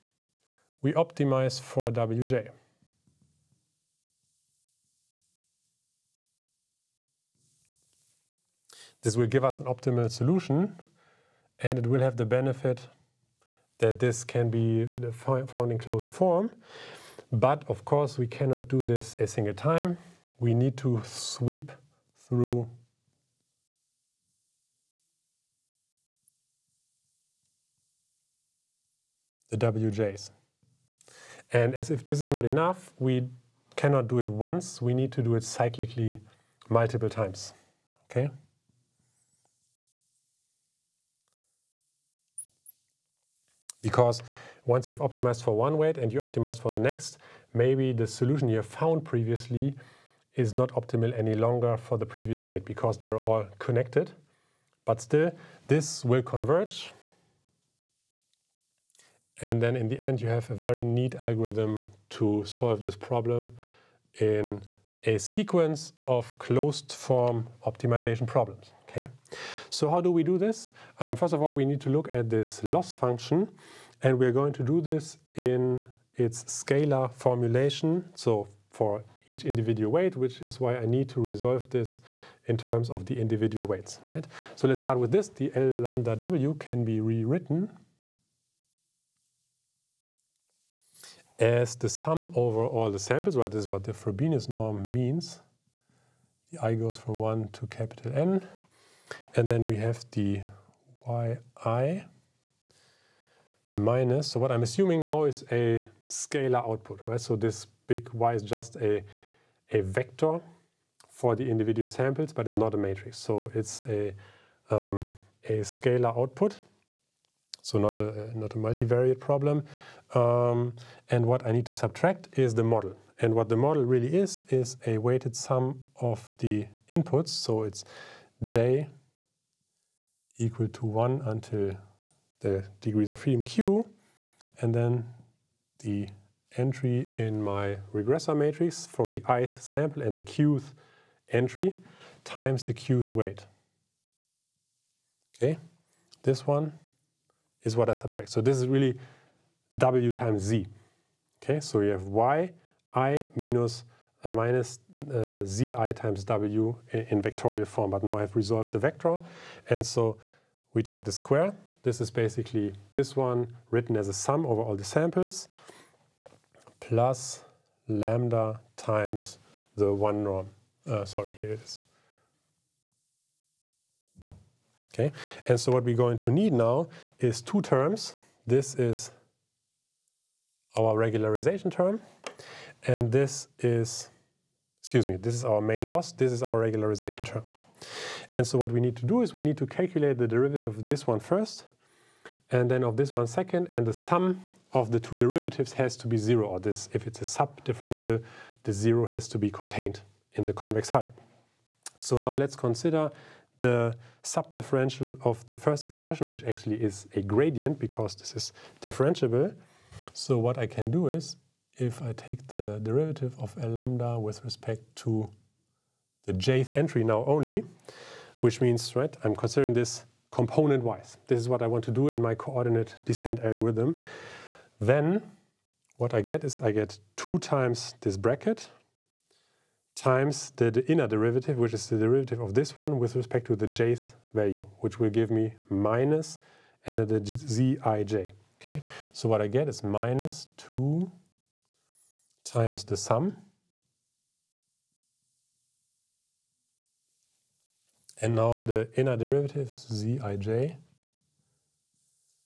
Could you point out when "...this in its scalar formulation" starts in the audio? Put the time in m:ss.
1:14.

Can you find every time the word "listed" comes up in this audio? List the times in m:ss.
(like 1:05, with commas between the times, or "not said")
not said.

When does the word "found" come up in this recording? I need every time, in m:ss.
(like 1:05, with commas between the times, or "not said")
0:15, 0:48.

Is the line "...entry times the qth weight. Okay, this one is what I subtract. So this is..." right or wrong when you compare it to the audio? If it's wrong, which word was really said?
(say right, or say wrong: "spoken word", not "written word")
right.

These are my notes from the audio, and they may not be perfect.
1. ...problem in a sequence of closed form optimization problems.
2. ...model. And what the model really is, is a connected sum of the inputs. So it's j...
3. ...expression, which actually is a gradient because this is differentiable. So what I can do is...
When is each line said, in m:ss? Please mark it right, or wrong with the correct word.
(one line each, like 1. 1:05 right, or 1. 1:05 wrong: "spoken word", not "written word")
1. 1:02 right
2. 2:02 wrong: "weighted", not "connected"
3. 3:25 right.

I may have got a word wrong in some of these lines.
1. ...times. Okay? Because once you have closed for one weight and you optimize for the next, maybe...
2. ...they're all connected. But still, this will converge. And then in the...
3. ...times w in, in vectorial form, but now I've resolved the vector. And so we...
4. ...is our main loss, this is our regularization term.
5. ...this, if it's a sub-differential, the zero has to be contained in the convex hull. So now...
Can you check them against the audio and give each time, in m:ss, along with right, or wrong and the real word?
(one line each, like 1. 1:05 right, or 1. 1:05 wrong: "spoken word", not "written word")
1. 0:37 wrong: "optimized", not "closed"
2. 0:52 right
3. 2:35 right
4. 3:05 right
5. 3:16 right.